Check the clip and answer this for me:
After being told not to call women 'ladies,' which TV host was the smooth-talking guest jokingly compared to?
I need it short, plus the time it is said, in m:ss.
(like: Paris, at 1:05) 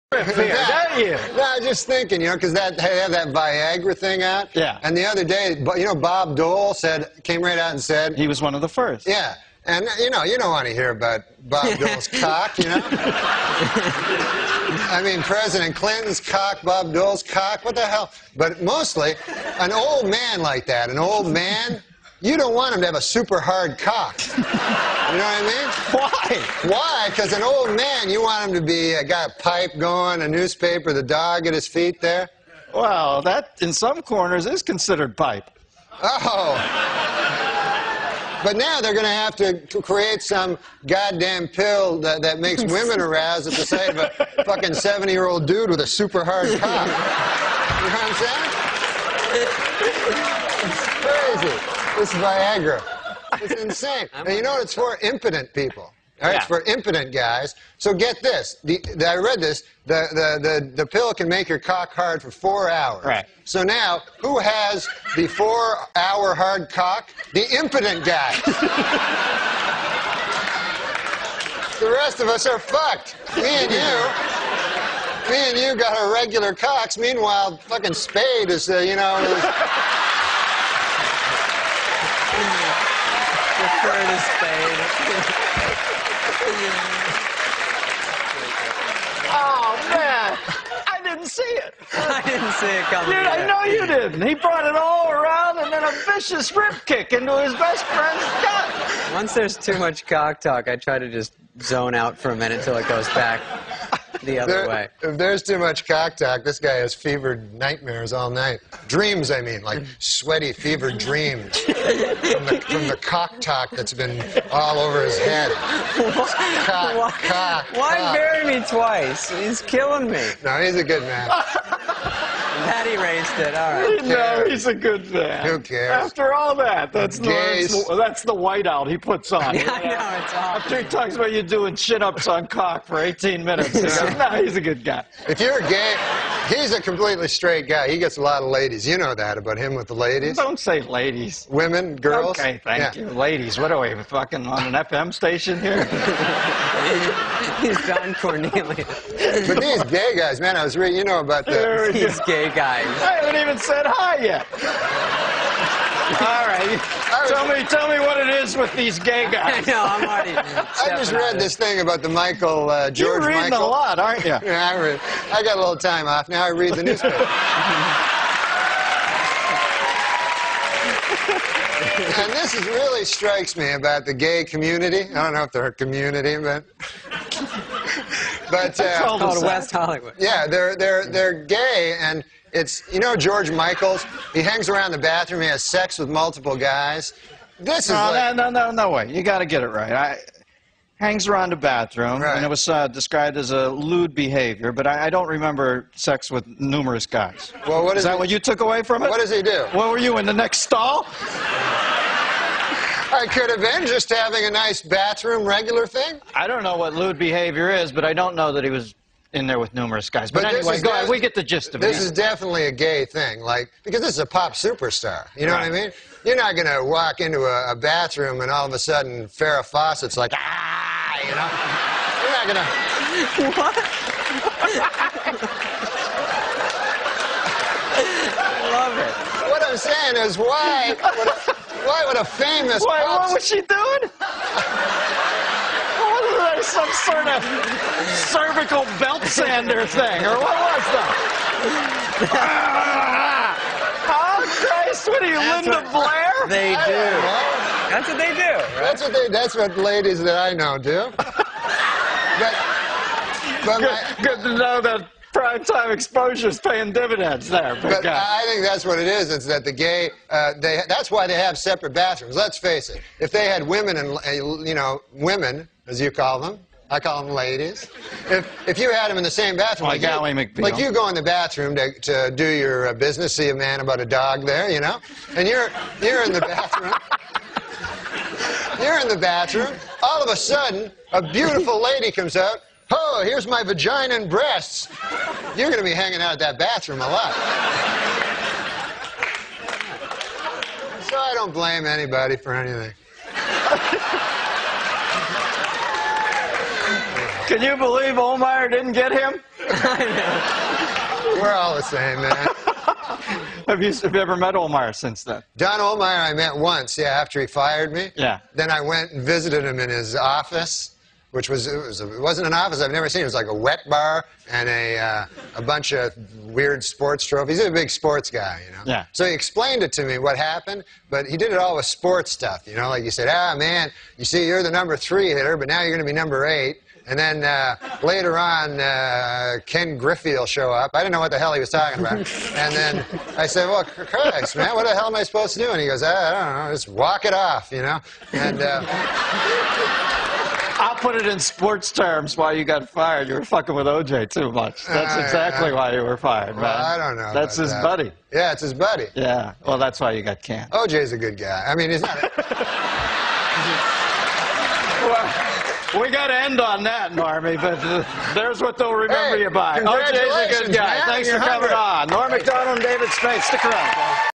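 Don Cornelius, at 2:27.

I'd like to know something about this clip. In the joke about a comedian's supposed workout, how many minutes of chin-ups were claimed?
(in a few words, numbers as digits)
18.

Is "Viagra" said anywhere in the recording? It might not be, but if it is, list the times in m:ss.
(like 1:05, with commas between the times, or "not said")
0:03, 0:52.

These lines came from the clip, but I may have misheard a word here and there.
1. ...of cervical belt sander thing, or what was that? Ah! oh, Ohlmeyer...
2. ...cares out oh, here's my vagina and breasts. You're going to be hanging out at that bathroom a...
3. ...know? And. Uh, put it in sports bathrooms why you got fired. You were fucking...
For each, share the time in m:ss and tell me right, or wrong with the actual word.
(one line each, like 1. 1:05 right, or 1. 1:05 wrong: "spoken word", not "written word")
1. 3:57 wrong: "Christ", not "Ohlmeyer"
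2. 4:42 wrong: "comes", not "cares"
3. 5:37 wrong: "terms", not "bathrooms".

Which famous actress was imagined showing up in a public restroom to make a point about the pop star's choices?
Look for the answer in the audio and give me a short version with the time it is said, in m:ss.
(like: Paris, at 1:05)
Farrah Fawcett, at 3:39.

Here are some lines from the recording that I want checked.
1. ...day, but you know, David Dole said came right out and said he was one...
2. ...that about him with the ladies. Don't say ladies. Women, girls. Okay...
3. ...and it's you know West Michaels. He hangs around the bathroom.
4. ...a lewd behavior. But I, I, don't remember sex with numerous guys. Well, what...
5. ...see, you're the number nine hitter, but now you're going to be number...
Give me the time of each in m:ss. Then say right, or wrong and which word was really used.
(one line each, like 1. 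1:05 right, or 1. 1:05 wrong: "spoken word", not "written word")
1. 0:05 wrong: "Bob", not "David"
2. 2:19 right
3. 3:01 wrong: "George", not "West"
4. 3:13 right
5. 5:24 wrong: "three", not "nine".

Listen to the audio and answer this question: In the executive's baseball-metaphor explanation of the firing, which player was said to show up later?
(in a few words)
Ken Griffey.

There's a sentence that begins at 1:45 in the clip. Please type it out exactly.
If there's too much cock talk, this guy has fevered nightmares all night.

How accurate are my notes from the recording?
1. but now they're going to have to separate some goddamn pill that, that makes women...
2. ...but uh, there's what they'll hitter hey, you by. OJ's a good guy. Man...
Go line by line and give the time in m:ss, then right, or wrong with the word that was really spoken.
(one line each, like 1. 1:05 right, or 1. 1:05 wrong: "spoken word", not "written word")
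1. 0:38 wrong: "create", not "separate"
2. 5:57 wrong: "remember", not "hitter".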